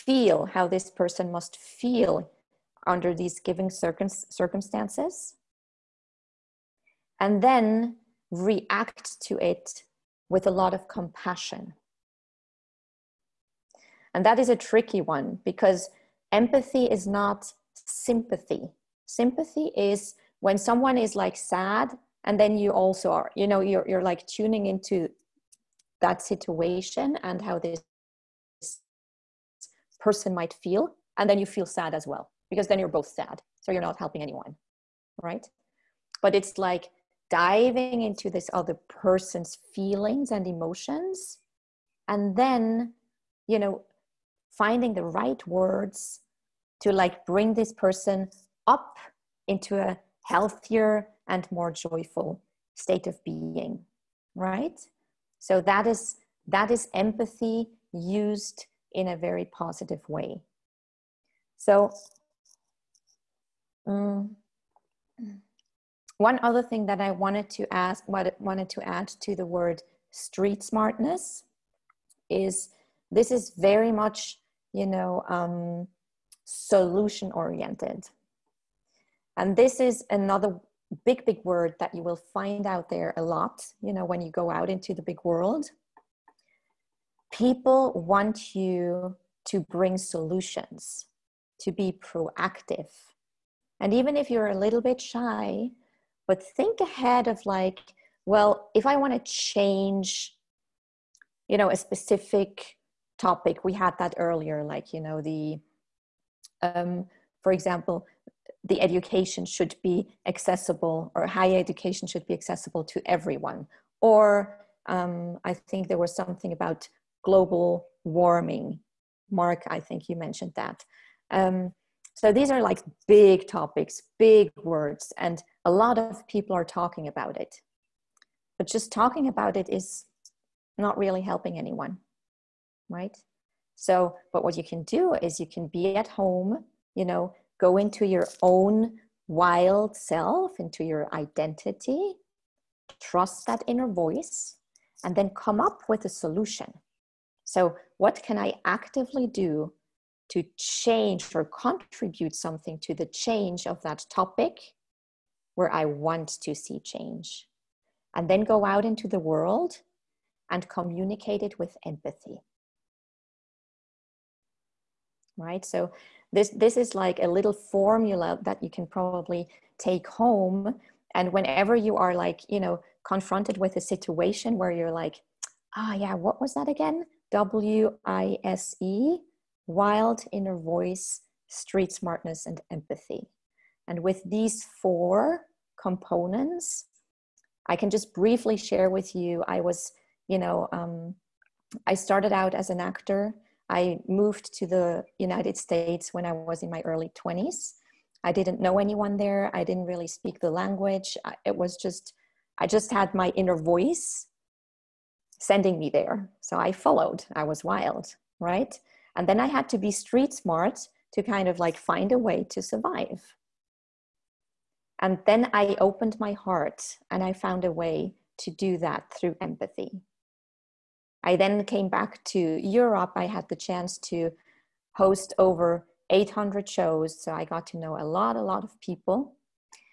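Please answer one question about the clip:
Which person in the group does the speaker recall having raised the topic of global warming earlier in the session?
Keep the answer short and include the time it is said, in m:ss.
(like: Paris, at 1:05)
Mark, at 1:59.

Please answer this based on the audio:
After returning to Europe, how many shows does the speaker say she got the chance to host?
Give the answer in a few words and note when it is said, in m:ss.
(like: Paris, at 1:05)
800, at 3:46.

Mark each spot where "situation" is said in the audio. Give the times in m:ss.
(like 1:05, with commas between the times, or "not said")
0:26, 2:53.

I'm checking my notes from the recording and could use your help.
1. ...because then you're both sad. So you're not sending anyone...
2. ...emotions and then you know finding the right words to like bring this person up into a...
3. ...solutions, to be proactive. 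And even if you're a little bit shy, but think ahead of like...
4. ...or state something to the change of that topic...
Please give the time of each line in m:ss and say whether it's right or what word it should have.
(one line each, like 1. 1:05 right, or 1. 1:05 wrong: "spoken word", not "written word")
1. 0:32 wrong: "helping", not "sending"
2. 0:40 right
3. 1:29 right
4. 2:31 wrong: "contribute", not "state".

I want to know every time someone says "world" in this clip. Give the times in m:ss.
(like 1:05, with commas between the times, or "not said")
1:25, 2:39.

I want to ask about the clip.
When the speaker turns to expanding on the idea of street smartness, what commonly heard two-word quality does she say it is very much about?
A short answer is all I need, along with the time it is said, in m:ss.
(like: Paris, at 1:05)
solution oriented, at 1:16.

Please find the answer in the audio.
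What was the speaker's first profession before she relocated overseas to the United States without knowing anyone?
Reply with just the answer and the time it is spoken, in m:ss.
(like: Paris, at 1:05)
actor, at 3:12.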